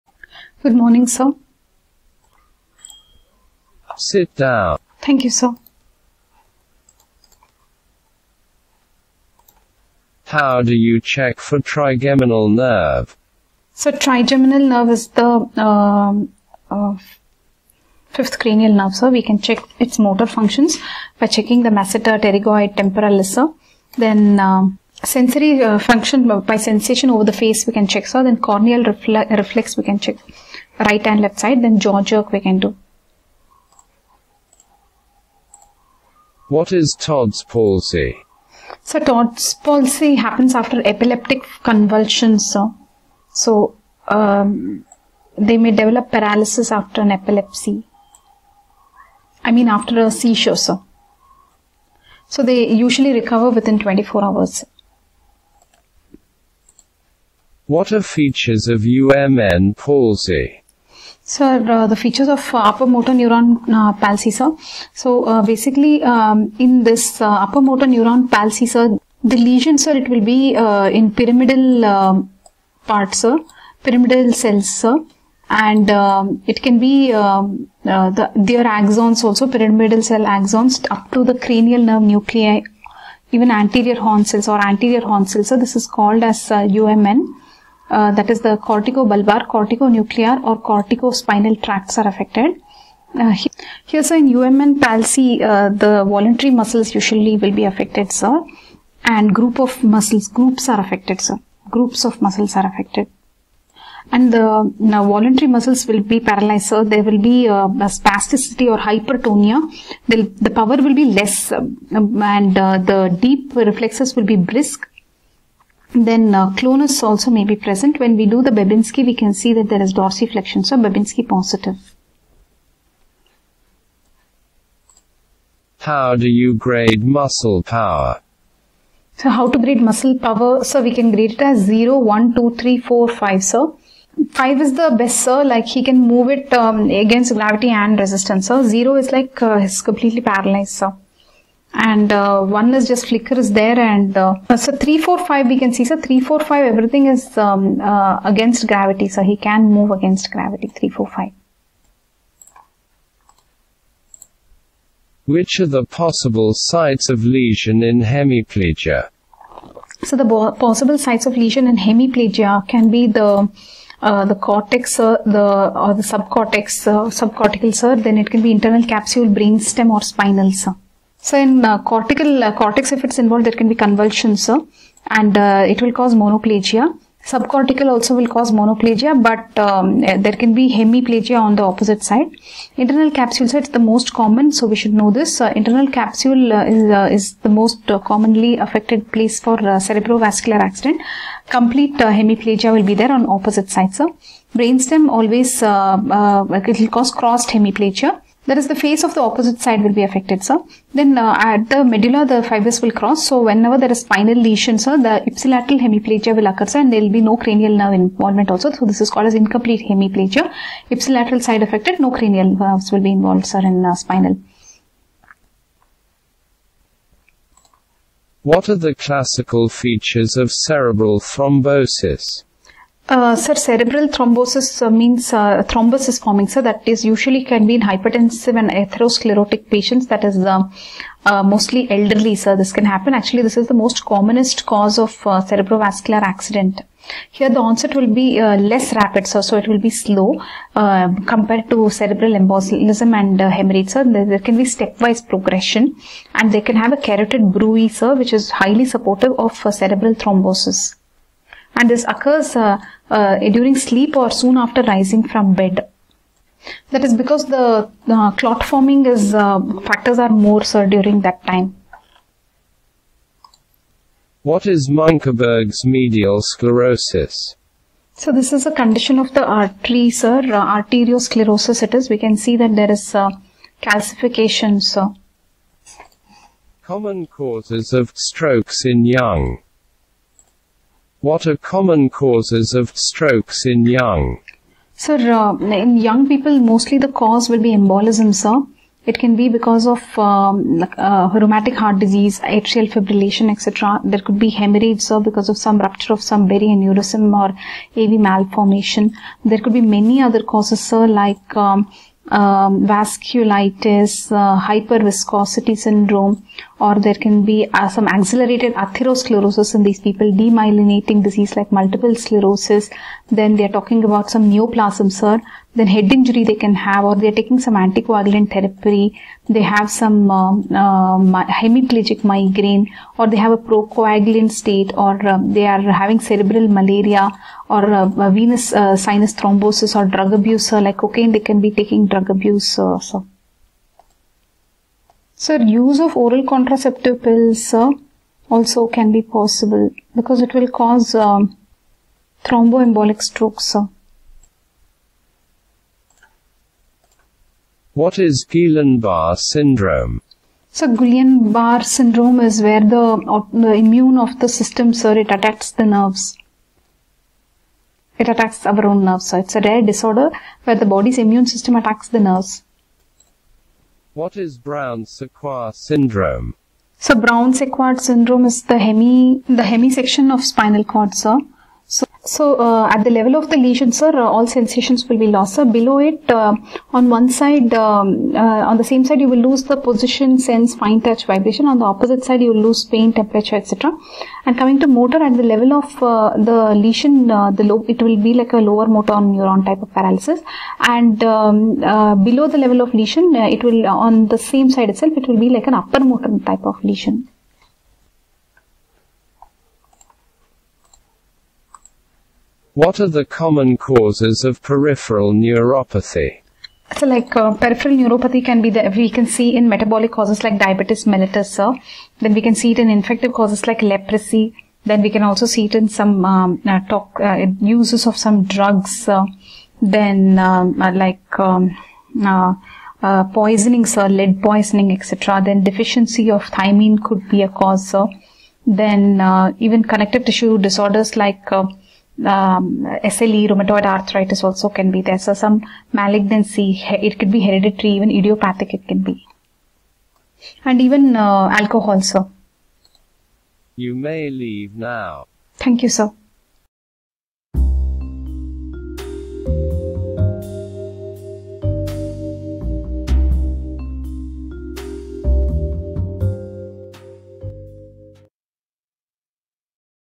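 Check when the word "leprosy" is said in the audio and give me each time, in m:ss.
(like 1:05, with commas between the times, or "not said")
6:53.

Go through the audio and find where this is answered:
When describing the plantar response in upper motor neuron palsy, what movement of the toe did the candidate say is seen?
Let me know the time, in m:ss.
1:59.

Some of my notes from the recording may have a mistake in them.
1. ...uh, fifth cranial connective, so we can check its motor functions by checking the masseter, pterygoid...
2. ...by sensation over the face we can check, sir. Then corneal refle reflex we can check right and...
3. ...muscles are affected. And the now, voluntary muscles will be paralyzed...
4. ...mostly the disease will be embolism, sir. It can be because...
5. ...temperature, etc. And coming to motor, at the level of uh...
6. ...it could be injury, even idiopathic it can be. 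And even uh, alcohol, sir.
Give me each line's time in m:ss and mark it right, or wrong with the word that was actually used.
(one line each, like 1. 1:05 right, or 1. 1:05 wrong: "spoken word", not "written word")
1. 0:16 wrong: "nerve", not "connective"
2. 0:26 right
3. 1:42 right
4. 4:46 wrong: "cause", not "disease"
5. 6:23 right
6. 7:16 wrong: "hereditary", not "injury".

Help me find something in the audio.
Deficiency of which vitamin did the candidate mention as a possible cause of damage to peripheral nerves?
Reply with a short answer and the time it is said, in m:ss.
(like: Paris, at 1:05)
Thiamine, at 7:06.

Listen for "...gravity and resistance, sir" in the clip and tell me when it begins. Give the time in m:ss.
2:17.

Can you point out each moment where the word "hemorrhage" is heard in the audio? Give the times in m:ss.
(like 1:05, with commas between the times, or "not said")
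4:03, 4:54.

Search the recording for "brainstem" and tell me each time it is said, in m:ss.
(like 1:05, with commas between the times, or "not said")
2:49, 3:14.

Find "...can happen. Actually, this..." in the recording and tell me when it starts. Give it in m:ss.
3:52.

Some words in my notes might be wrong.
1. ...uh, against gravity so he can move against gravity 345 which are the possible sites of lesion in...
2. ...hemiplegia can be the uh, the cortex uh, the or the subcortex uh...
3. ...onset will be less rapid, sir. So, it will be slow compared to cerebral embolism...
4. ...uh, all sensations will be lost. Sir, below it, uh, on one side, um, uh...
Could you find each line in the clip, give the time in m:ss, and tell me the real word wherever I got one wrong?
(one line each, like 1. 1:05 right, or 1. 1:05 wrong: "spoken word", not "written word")
1. 2:27 right
2. 2:41 right
3. 3:57 right
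4. 6:14 right.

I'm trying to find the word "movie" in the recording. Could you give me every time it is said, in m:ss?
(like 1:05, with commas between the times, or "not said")
not said.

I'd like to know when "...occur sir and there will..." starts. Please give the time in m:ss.
3:26.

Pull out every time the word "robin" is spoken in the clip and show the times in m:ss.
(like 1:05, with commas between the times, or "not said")
not said.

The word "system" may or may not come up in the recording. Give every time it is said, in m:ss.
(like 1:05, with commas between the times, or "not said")
5:54, 6:01.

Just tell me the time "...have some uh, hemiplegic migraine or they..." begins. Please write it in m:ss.
5:19.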